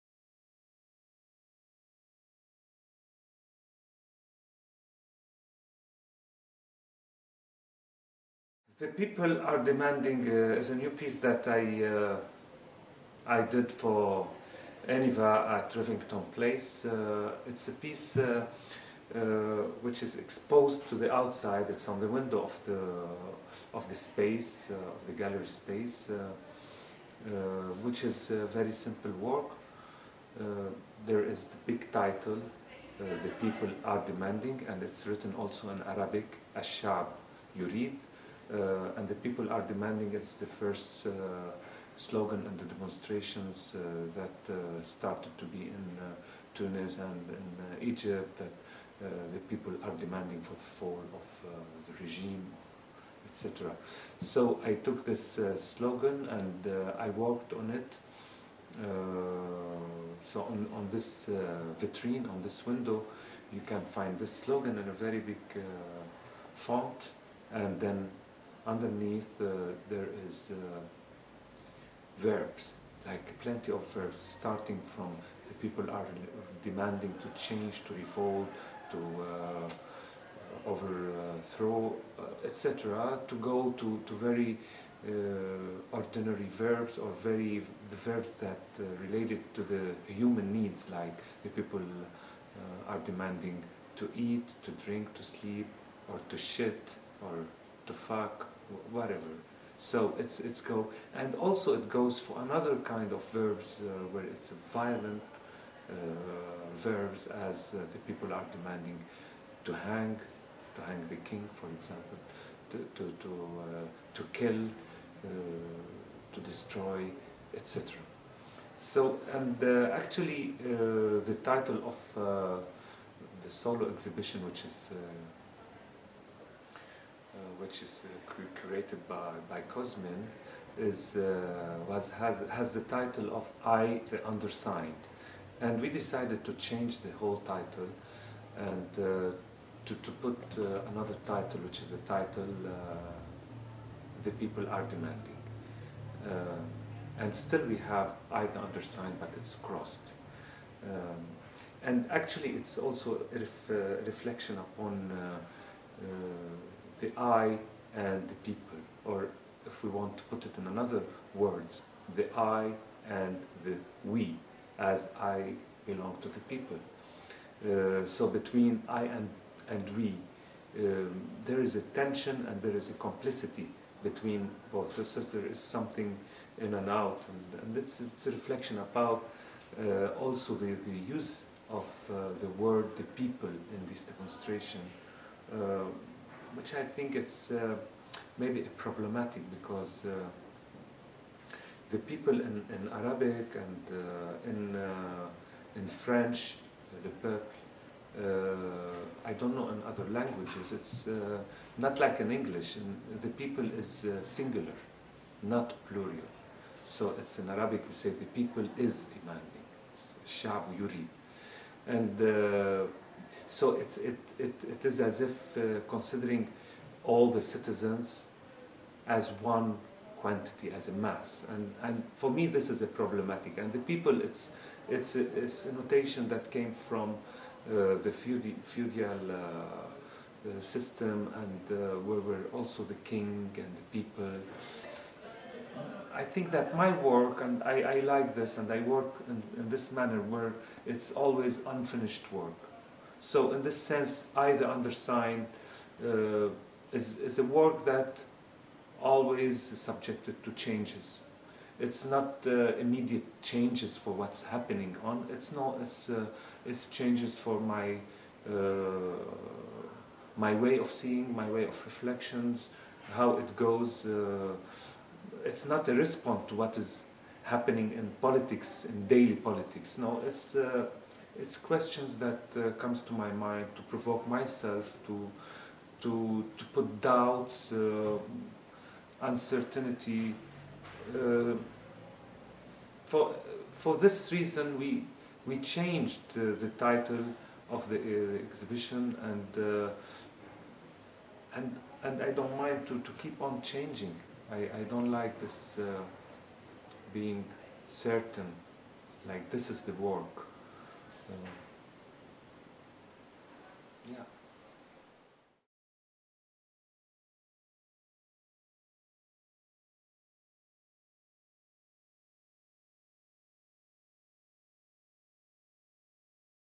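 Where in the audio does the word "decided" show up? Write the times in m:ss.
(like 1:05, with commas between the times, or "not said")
2:15.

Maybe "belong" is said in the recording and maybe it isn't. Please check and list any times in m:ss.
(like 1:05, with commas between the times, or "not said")
2:45.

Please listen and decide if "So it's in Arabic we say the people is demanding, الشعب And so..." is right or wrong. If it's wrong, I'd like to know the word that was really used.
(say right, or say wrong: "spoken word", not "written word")
right.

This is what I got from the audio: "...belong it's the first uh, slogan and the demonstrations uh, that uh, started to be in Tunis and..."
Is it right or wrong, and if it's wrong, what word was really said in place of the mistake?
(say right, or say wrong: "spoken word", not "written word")
wrong: "demanding", not "belong".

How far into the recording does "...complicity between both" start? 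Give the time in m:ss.
2:52.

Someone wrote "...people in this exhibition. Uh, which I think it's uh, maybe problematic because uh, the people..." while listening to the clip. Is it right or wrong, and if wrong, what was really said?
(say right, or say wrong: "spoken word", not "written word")
wrong: "demonstration", not "exhibition".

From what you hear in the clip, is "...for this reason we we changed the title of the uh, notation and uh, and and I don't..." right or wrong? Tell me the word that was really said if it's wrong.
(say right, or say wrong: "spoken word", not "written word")
wrong: "exhibition", not "notation".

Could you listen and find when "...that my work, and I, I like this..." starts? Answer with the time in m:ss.
3:56.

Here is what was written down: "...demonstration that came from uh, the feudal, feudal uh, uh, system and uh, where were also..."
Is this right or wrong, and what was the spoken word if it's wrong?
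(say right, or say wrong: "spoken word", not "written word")
wrong: "notation", not "demonstration".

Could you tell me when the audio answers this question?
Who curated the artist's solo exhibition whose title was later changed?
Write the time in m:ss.
2:09.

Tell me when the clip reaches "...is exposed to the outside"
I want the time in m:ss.
0:20.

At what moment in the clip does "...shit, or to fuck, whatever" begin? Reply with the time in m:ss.
1:36.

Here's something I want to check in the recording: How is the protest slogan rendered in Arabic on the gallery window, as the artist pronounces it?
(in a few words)
Ashab Yurid.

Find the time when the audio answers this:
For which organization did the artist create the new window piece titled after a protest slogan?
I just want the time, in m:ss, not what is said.
0:14.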